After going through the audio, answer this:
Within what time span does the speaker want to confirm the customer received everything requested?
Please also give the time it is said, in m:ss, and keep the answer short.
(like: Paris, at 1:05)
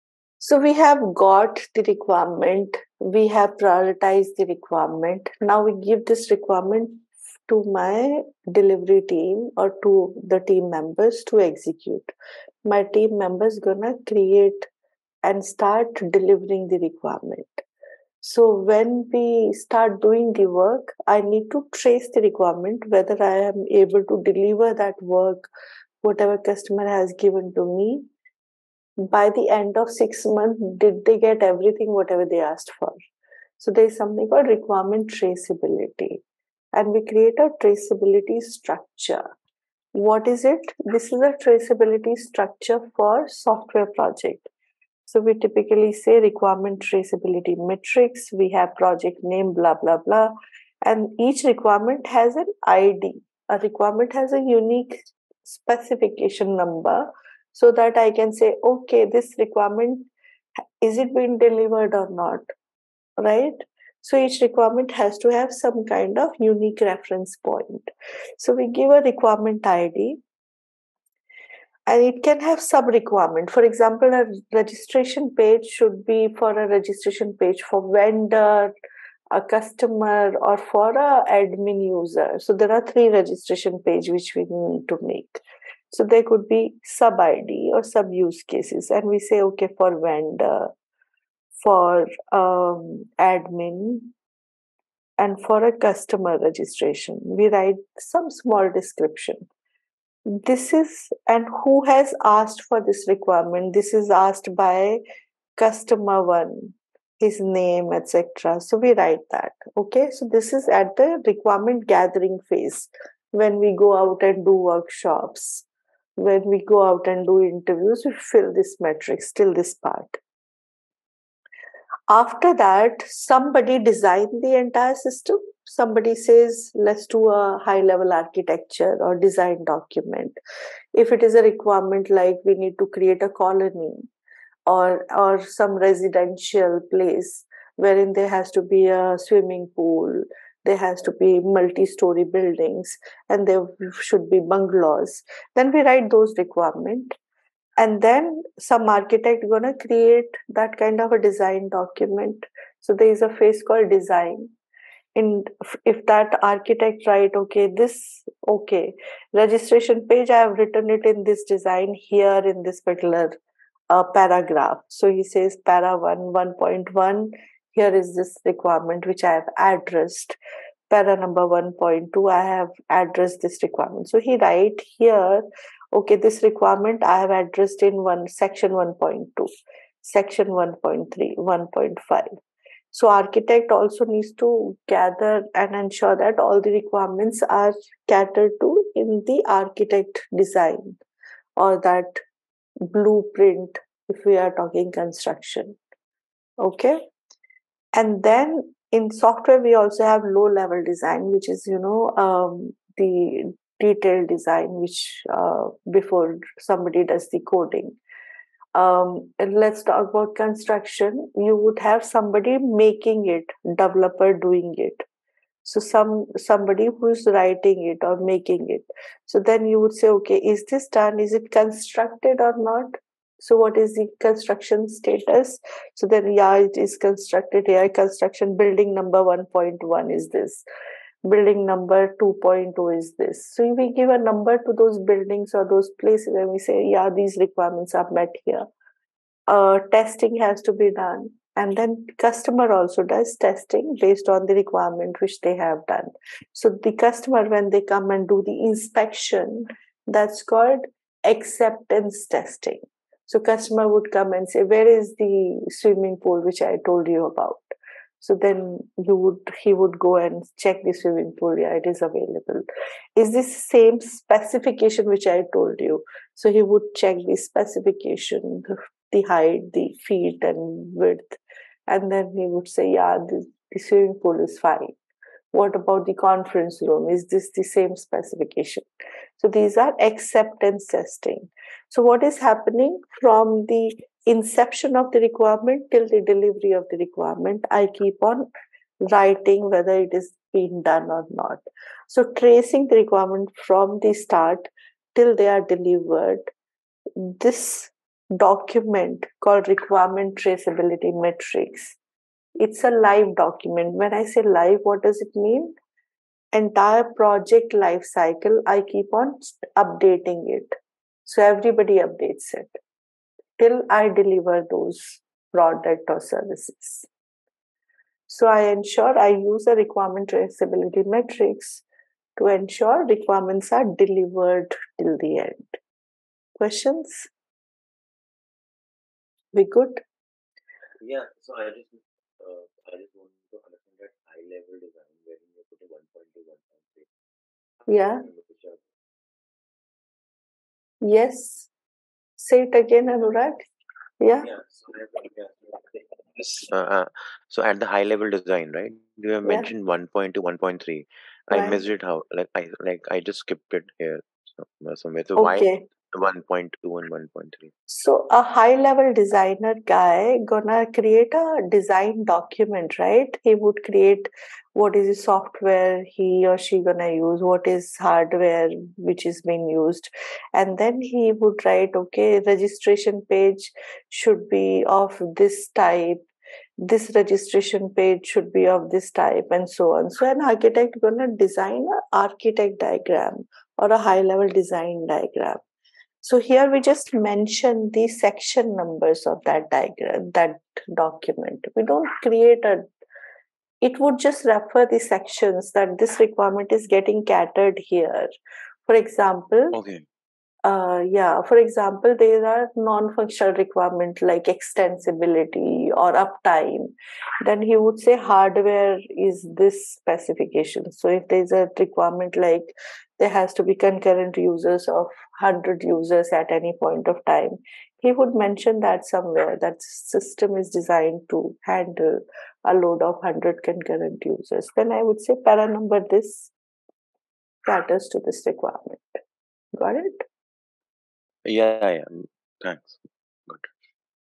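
6 months, at 0:29.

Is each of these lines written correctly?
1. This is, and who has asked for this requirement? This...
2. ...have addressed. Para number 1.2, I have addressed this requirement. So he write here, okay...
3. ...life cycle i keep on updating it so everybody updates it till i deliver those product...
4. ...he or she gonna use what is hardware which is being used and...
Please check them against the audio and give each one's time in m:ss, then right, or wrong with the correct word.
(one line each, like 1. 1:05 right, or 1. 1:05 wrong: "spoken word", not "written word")
1. 1:40 right
2. 2:49 right
3. 5:07 right
4. 6:06 right.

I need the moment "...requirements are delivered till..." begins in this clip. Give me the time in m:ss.
5:23.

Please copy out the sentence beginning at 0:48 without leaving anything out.
We have project name, blah, blah, blah.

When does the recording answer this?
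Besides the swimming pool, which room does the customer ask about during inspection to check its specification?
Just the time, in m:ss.
4:36.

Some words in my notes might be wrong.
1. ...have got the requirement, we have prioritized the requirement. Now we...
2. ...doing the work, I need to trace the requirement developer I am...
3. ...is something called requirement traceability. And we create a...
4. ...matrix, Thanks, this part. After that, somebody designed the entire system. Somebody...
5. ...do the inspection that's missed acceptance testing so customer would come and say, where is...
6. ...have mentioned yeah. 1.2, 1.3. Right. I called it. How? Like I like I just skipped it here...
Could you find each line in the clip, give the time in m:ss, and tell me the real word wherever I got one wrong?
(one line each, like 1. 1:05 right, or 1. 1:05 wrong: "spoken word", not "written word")
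1. 0:00 right
2. 0:20 wrong: "whether", not "developer"
3. 0:33 right
4. 1:58 wrong: "Still", not "Thanks"
5. 4:08 wrong: "called", not "missed"
6. 5:49 wrong: "missed", not "called".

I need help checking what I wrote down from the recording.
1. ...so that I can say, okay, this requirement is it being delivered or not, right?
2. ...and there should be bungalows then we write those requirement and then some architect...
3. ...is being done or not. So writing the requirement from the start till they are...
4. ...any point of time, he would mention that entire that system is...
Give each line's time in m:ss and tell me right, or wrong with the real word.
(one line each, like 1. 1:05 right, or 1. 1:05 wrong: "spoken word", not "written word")
1. 0:57 right
2. 2:23 right
3. 4:50 wrong: "tracing", not "writing"
4. 6:56 wrong: "somewhere", not "entire".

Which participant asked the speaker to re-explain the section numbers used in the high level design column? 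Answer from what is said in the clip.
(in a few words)
Anurag.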